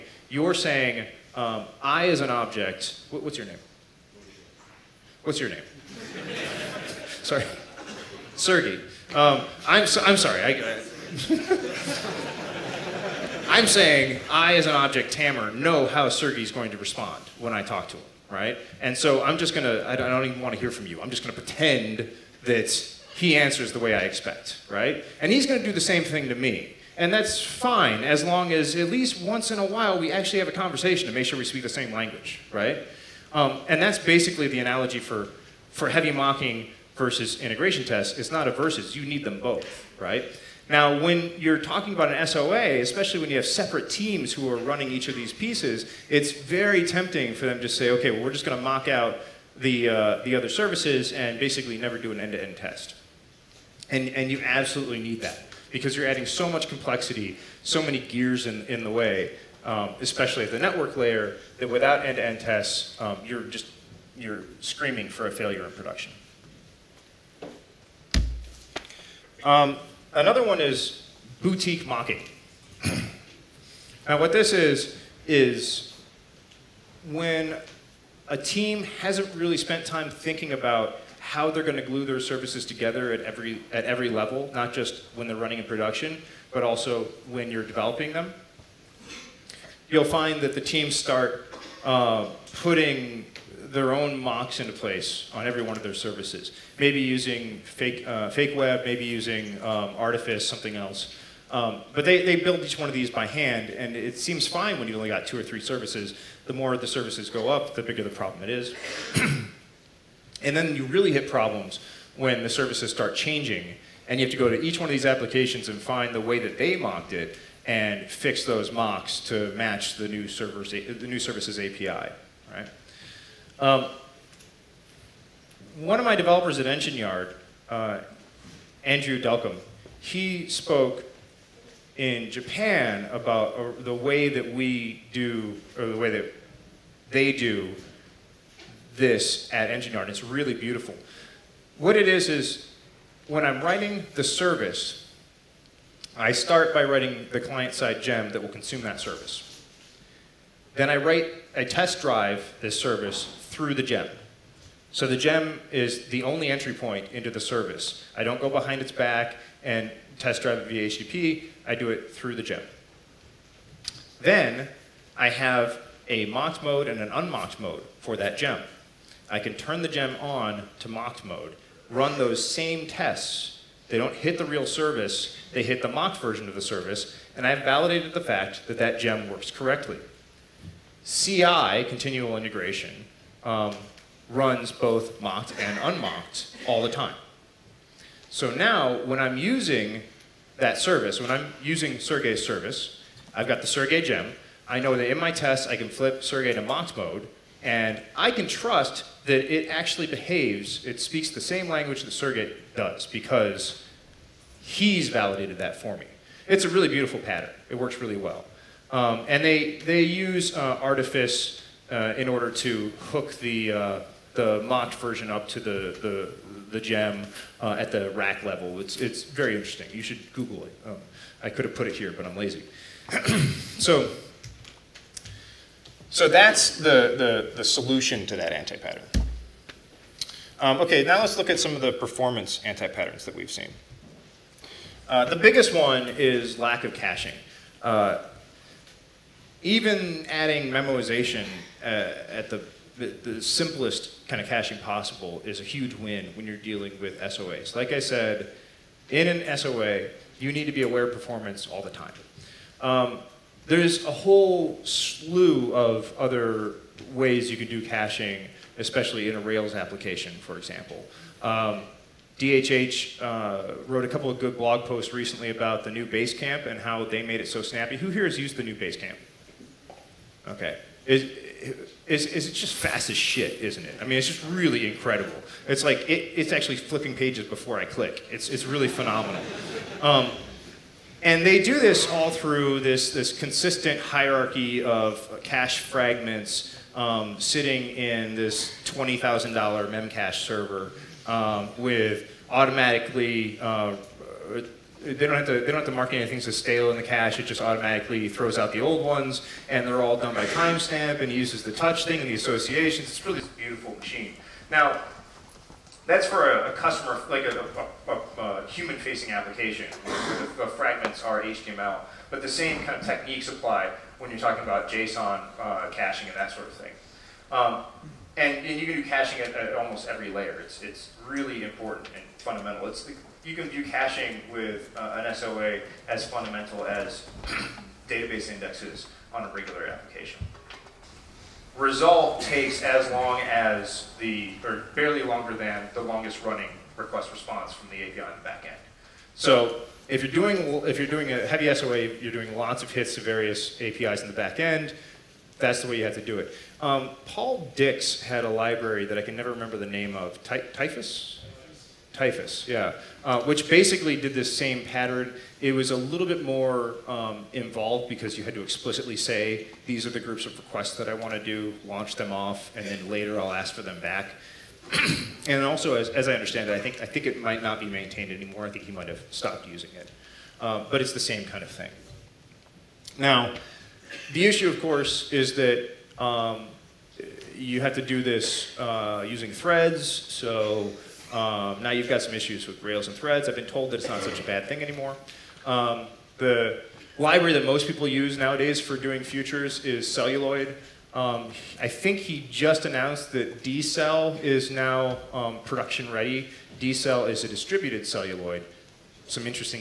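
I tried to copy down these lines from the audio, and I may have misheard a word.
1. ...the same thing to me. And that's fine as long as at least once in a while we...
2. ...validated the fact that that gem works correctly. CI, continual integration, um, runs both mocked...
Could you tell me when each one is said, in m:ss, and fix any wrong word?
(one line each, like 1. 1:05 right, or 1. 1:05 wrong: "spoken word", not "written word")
1. 0:25 right
2. 2:57 right.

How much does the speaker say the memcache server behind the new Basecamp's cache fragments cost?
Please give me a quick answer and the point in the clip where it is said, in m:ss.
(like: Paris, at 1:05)
$20,000, at 4:48.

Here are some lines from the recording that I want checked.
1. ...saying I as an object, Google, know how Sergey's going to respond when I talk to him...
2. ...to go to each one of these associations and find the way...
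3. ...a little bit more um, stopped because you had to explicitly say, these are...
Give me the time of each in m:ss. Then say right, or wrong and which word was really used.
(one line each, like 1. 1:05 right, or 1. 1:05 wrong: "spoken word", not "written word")
1. 0:13 wrong: "Tammer", not "Google"
2. 1:54 wrong: "applications", not "associations"
3. 5:55 wrong: "involved", not "stopped".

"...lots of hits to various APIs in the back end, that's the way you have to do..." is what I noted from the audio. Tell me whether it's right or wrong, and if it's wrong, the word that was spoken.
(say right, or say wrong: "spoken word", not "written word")
right.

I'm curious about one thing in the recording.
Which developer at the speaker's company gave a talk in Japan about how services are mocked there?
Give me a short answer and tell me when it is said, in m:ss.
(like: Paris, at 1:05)
Andrew Delcambre, at 2:08.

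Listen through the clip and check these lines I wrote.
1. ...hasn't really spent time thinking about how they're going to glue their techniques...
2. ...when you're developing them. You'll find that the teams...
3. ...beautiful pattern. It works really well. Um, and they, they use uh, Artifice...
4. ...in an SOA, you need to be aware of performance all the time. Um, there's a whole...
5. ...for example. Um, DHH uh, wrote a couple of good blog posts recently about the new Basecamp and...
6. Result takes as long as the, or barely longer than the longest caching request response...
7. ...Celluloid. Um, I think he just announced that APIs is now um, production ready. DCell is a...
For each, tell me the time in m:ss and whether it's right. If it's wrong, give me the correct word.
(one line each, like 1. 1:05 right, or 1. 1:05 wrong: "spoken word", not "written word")
1. 1:19 wrong: "services", not "techniques"
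2. 1:27 right
3. 3:26 right
4. 4:09 right
5. 4:20 right
6. 5:31 wrong: "running", not "caching"
7. 6:30 wrong: "DCell", not "APIs".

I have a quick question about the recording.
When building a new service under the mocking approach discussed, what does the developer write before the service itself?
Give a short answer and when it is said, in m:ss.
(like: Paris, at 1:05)
client-side gem, at 2:27.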